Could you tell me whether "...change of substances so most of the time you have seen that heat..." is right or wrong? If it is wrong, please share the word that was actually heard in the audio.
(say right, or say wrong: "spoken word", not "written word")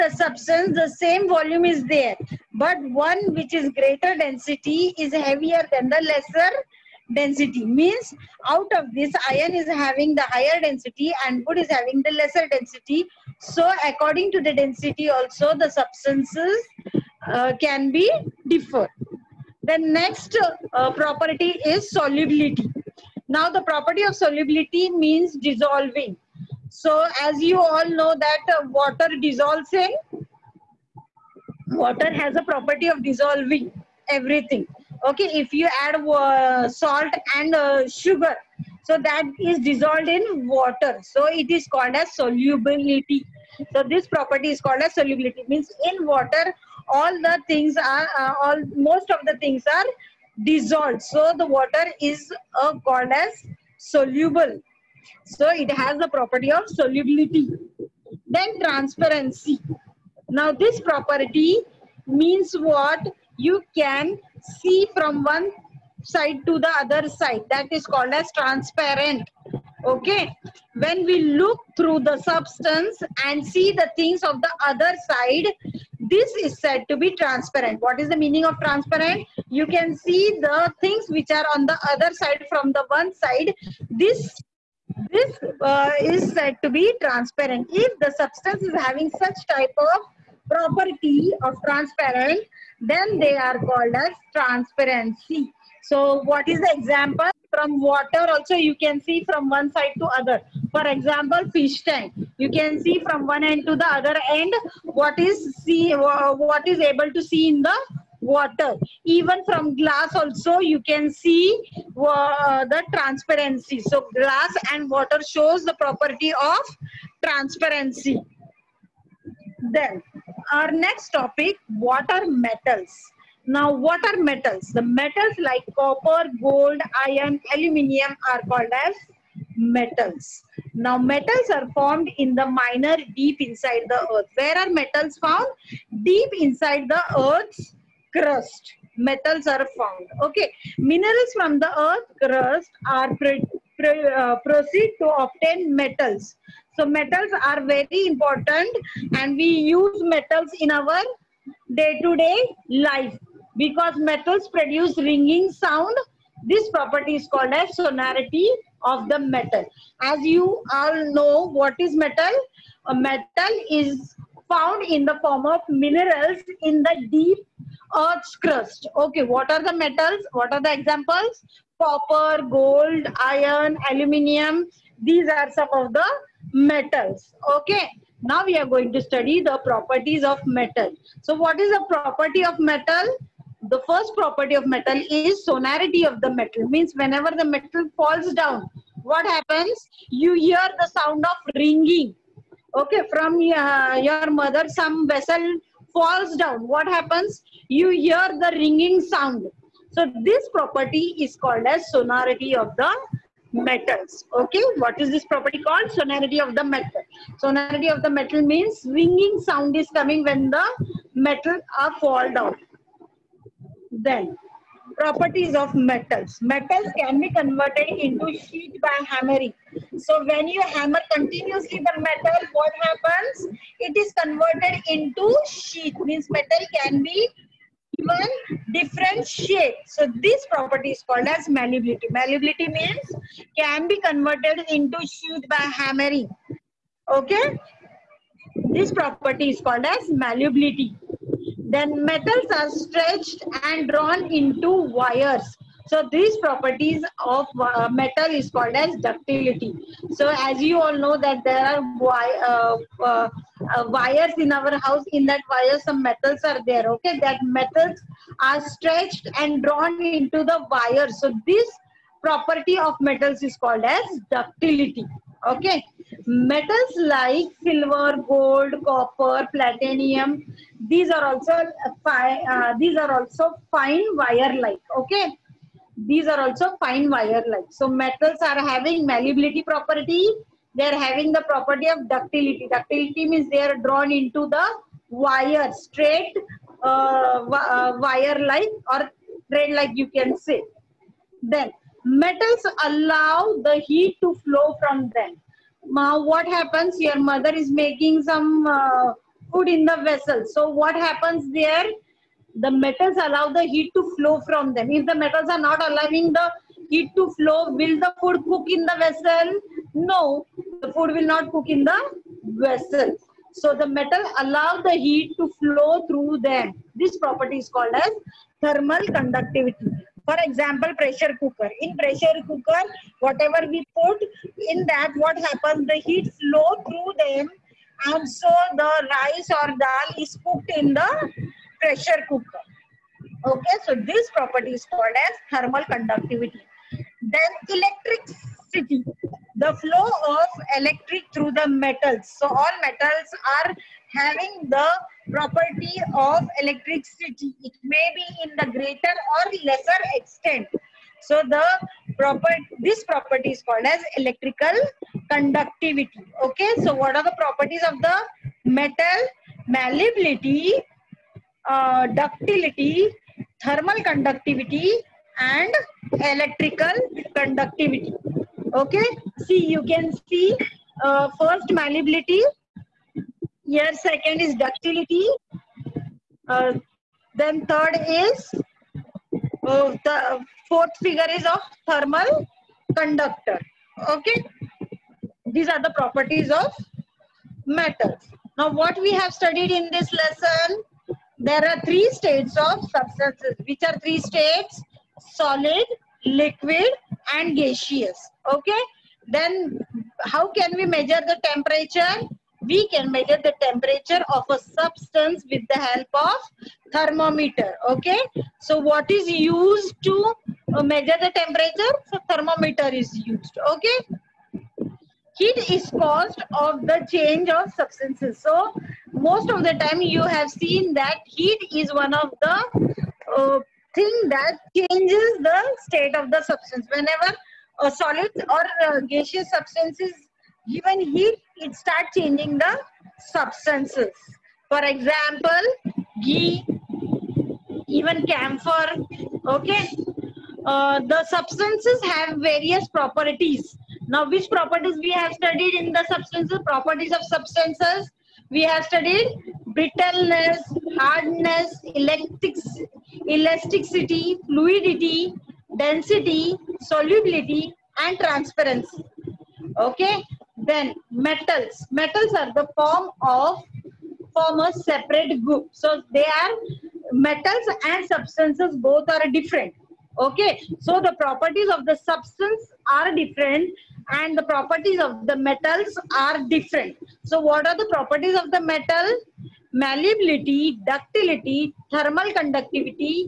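right.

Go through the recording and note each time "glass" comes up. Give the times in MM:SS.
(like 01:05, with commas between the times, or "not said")
01:49, 01:54.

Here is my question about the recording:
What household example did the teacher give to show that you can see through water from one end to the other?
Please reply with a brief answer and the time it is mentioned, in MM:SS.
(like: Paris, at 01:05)
Fish tank, at 01:41.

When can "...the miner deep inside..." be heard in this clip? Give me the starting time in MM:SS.
02:12.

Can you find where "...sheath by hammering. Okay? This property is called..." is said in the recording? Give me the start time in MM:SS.
03:55.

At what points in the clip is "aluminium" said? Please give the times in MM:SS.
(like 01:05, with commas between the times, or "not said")
02:07, 02:53.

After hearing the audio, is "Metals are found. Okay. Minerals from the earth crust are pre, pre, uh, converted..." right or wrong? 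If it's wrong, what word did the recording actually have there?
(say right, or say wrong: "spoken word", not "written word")
wrong: "proceed", not "converted".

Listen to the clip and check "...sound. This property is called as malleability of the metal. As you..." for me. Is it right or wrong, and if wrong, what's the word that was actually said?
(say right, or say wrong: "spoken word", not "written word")
wrong: "sonority", not "malleability".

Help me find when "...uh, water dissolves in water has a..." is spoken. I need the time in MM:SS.
00:28.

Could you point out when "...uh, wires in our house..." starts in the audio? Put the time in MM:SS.
04:13.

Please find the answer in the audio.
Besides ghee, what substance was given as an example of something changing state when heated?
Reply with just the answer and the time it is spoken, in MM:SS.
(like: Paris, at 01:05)
Camphor, at 07:18.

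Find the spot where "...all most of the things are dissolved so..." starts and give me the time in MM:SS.
00:48.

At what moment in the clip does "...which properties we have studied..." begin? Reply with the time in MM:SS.
07:24.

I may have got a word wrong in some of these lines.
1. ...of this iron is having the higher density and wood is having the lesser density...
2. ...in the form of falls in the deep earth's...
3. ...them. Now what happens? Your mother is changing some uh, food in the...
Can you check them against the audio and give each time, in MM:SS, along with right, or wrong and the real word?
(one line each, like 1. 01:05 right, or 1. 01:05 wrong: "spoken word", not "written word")
1. 00:08 right
2. 02:44 wrong: "minerals", not "falls"
3. 04:55 wrong: "making", not "changing".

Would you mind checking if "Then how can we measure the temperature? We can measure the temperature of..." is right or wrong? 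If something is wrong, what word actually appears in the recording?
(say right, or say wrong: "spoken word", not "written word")
right.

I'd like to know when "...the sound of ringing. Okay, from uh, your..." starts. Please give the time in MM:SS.
03:10.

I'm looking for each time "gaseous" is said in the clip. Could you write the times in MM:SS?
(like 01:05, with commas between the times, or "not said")
06:37, 07:09.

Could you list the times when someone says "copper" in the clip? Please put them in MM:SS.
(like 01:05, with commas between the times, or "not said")
02:05, 02:51, 04:28.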